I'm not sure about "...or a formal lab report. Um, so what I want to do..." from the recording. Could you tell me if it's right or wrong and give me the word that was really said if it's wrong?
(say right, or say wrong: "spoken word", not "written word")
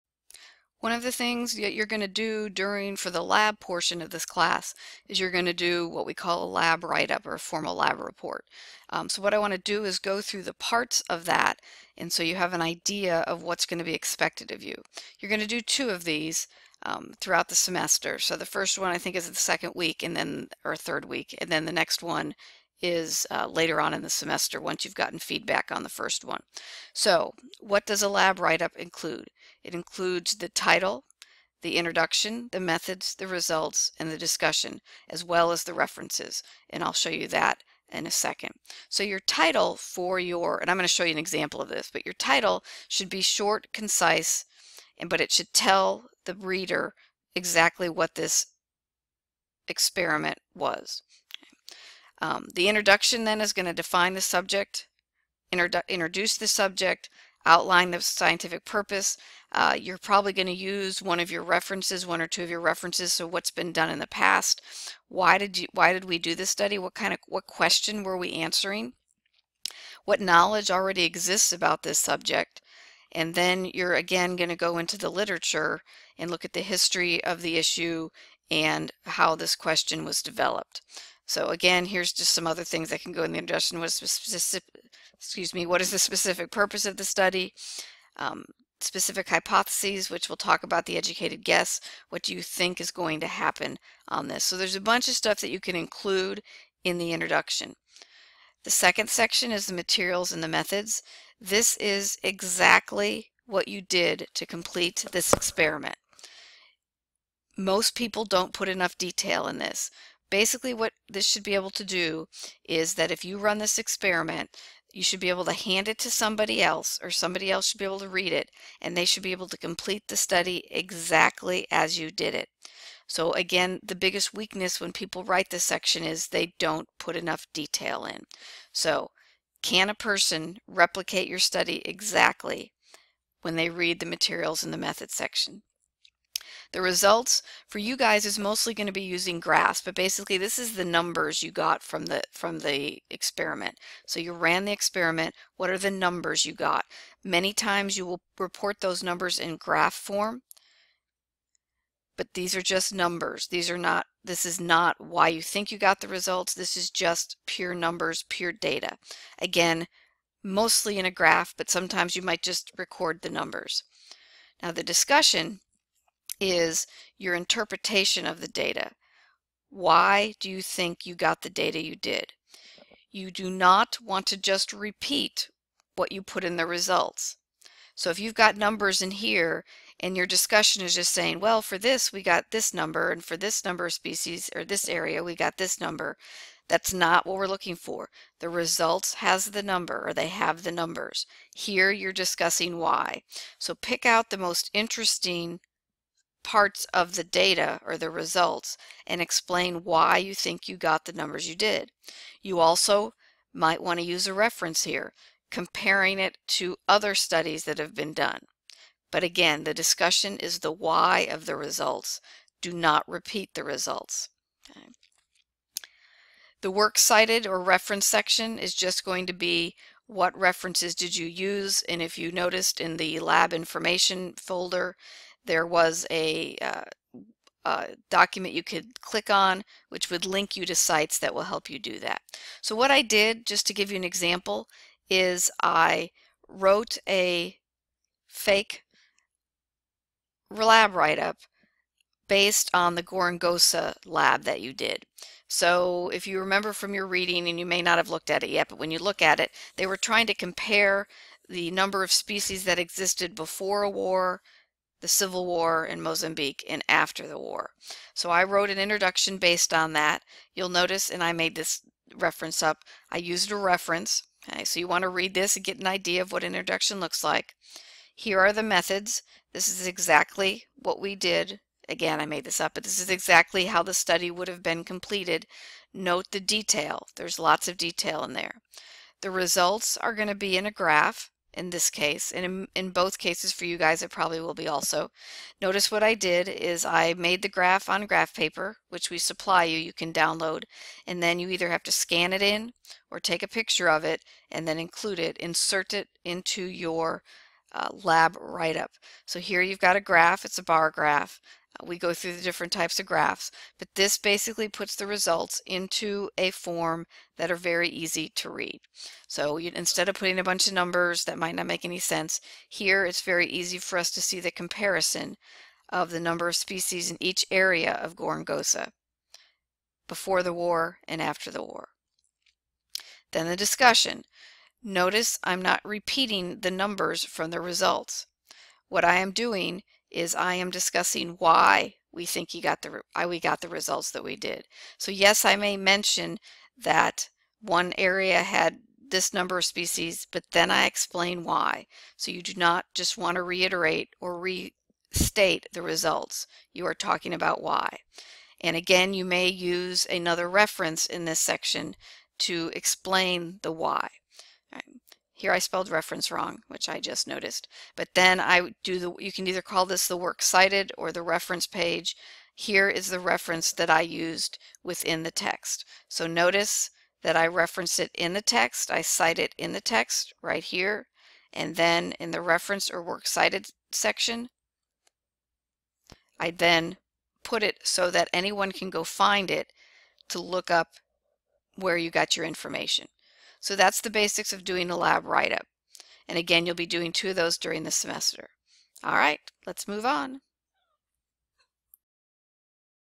right.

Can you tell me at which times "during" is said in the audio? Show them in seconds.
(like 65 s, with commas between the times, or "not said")
2 s, 387 s.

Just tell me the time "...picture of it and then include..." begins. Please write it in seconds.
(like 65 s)
293 s.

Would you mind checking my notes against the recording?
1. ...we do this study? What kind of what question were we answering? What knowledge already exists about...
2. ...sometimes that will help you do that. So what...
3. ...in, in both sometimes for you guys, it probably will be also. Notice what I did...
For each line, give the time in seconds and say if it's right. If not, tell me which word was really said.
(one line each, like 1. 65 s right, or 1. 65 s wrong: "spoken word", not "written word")
1. 66 s right
2. 230 s wrong: "sites", not "sometimes"
3. 282 s wrong: "cases", not "sometimes".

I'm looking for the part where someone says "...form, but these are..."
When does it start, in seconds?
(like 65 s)
149 s.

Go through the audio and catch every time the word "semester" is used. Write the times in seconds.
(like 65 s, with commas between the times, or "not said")
17 s, 24 s, 387 s.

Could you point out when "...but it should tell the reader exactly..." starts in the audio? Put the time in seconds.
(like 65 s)
45 s.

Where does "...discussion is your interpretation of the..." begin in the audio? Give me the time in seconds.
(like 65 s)
164 s.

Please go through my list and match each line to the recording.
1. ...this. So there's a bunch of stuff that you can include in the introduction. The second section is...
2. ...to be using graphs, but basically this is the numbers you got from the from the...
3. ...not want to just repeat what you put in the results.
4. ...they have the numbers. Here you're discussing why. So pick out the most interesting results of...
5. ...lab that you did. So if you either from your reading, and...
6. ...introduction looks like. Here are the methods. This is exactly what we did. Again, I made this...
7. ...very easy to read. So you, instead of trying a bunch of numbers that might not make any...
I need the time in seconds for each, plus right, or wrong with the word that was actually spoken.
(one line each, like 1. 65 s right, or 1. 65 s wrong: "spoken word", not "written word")
1. 94 s right
2. 138 s right
3. 173 s right
4. 190 s wrong: "parts", not "results"
5. 244 s wrong: "remember", not "either"
6. 266 s right
7. 307 s wrong: "putting", not "trying".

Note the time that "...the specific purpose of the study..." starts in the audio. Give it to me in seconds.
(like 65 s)
85 s.